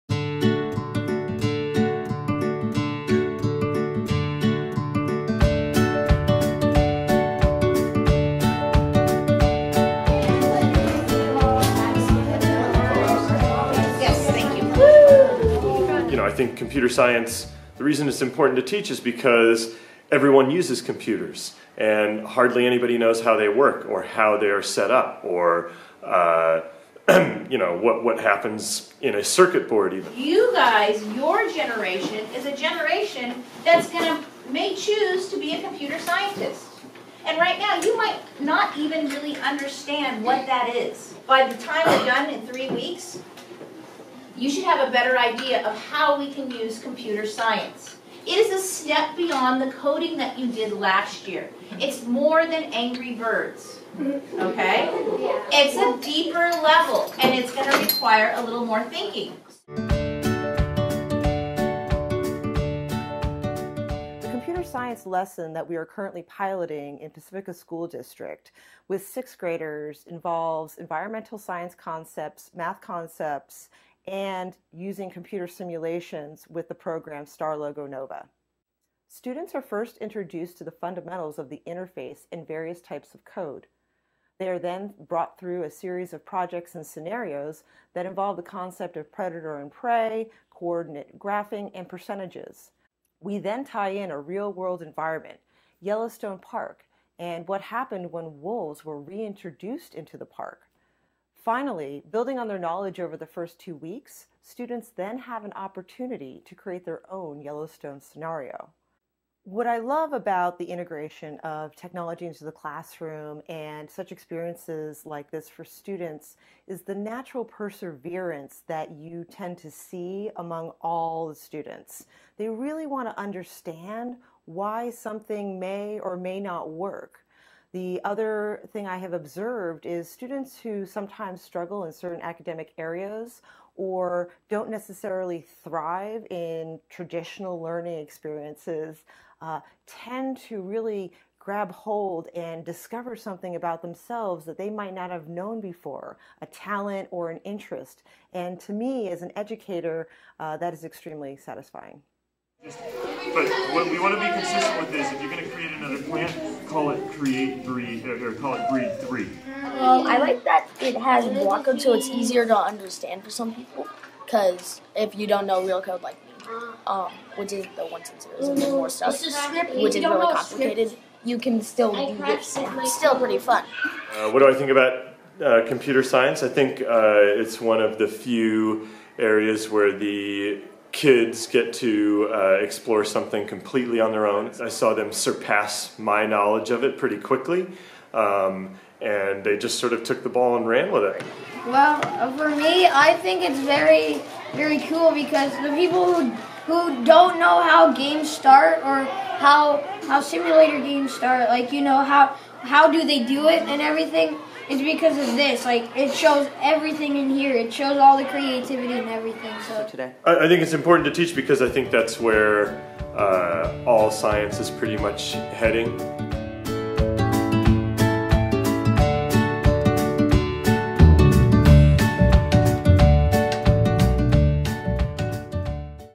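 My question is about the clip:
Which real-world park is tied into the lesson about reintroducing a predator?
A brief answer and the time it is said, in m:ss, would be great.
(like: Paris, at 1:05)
Yellowstone Park, at 1:35.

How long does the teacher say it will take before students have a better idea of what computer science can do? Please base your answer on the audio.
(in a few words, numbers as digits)
3 weeks.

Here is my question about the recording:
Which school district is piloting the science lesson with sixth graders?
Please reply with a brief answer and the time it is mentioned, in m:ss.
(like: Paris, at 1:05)
Pacifica School District, at 1:07.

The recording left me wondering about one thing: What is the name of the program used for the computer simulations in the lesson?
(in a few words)
StarLogo Nova.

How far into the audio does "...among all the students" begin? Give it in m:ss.
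2:00.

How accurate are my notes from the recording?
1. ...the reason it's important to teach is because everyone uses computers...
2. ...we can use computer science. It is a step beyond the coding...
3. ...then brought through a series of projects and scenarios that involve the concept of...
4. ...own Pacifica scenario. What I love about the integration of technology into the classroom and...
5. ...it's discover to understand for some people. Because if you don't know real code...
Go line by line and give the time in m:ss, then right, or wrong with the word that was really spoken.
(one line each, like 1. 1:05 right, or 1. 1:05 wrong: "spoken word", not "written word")
1. 0:17 right
2. 0:46 right
3. 1:24 right
4. 1:47 wrong: "Yellowstone", not "Pacifica"
5. 2:41 wrong: "easier", not "discover".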